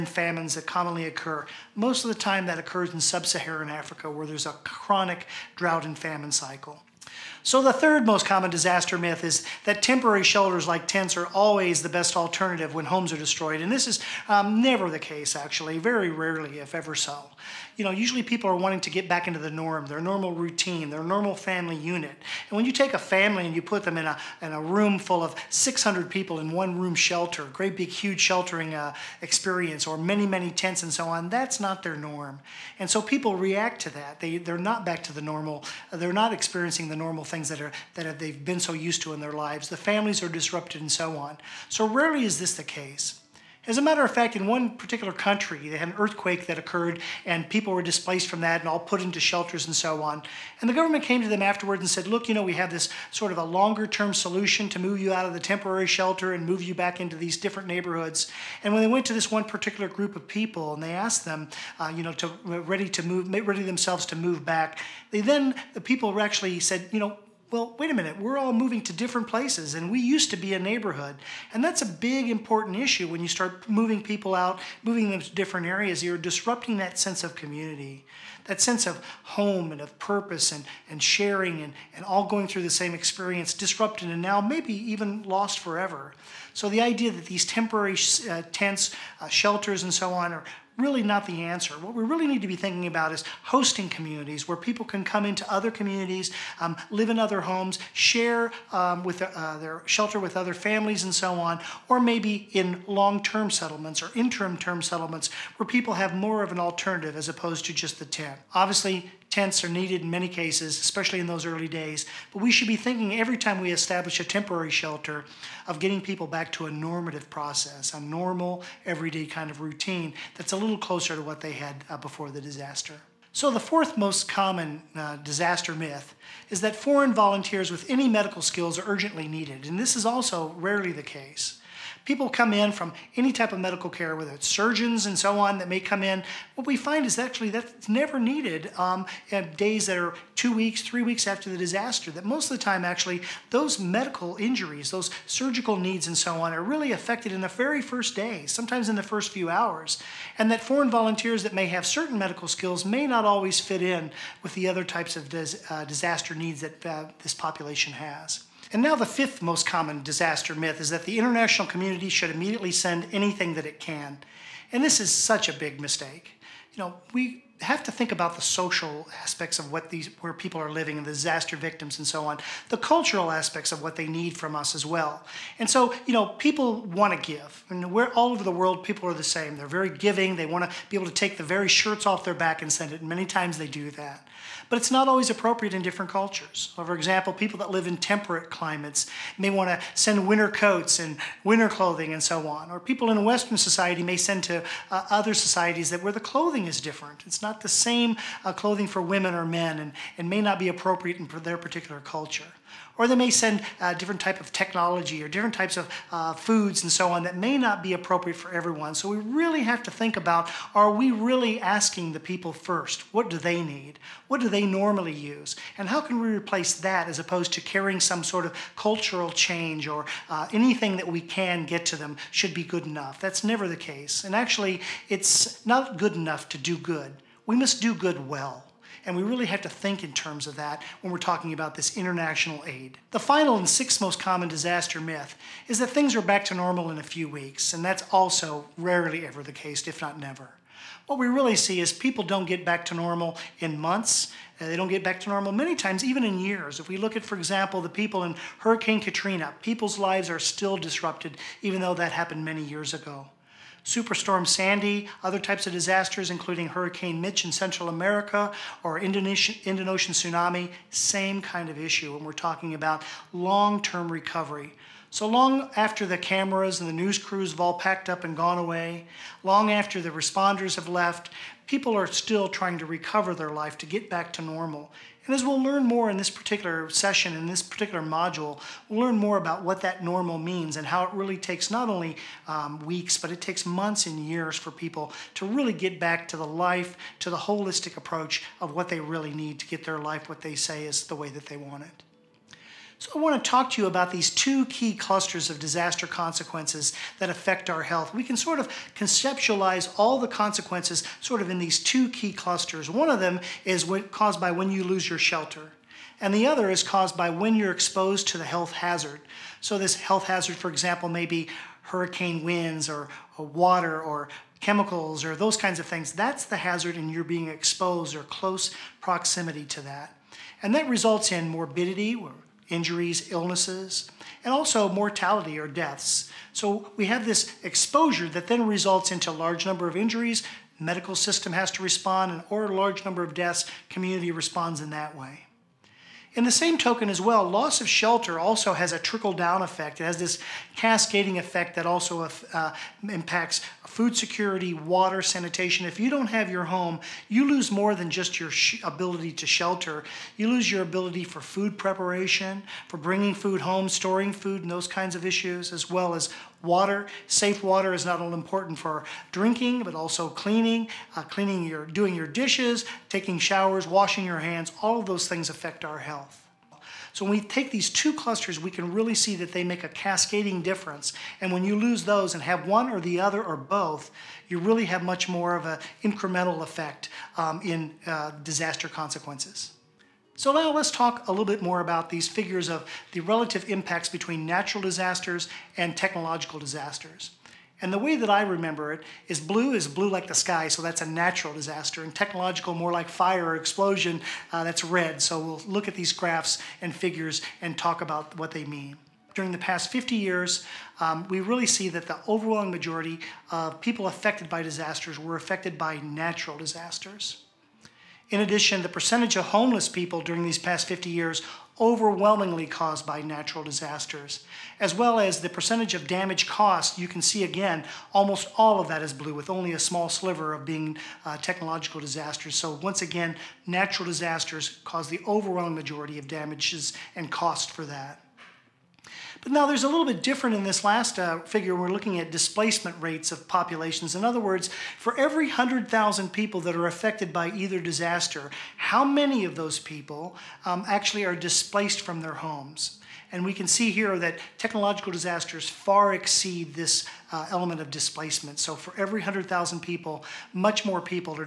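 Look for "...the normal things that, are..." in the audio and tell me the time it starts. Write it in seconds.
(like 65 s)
36 s.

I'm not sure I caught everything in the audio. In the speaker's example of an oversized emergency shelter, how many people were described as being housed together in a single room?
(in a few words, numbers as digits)
600.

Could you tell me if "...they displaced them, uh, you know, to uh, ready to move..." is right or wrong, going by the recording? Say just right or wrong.
wrong.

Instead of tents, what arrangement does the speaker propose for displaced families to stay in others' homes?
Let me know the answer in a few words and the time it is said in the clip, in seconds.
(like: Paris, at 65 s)
Hosting communities, at 93 s.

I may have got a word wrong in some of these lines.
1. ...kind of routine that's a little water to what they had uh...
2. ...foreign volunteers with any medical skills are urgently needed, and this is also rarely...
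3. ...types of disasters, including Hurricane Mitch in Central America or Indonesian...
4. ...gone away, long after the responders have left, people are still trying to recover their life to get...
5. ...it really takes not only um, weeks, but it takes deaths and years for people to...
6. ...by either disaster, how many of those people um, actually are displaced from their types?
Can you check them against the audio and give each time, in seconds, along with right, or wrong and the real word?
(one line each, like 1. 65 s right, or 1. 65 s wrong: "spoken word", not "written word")
1. 119 s wrong: "closer", not "water"
2. 126 s right
3. 255 s right
4. 268 s right
5. 281 s wrong: "months", not "deaths"
6. 437 s wrong: "homes", not "types".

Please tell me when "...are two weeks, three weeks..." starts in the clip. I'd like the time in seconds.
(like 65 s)
139 s.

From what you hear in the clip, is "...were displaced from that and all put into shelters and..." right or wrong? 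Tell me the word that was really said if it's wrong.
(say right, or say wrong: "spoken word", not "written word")
right.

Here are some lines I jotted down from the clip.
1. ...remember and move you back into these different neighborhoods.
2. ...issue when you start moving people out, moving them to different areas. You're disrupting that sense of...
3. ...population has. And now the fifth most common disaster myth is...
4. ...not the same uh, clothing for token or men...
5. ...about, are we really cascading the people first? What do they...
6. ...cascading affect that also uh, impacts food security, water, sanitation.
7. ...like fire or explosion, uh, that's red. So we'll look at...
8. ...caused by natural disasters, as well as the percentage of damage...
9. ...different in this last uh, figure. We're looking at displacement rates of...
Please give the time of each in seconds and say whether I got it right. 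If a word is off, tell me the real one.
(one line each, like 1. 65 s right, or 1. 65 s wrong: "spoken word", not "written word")
1. 55 s wrong: "shelter", not "remember"
2. 72 s right
3. 157 s right
4. 197 s wrong: "women", not "token"
5. 210 s wrong: "asking", not "cascading"
6. 340 s wrong: "effect", not "affect"
7. 392 s right
8. 412 s right
9. 430 s right.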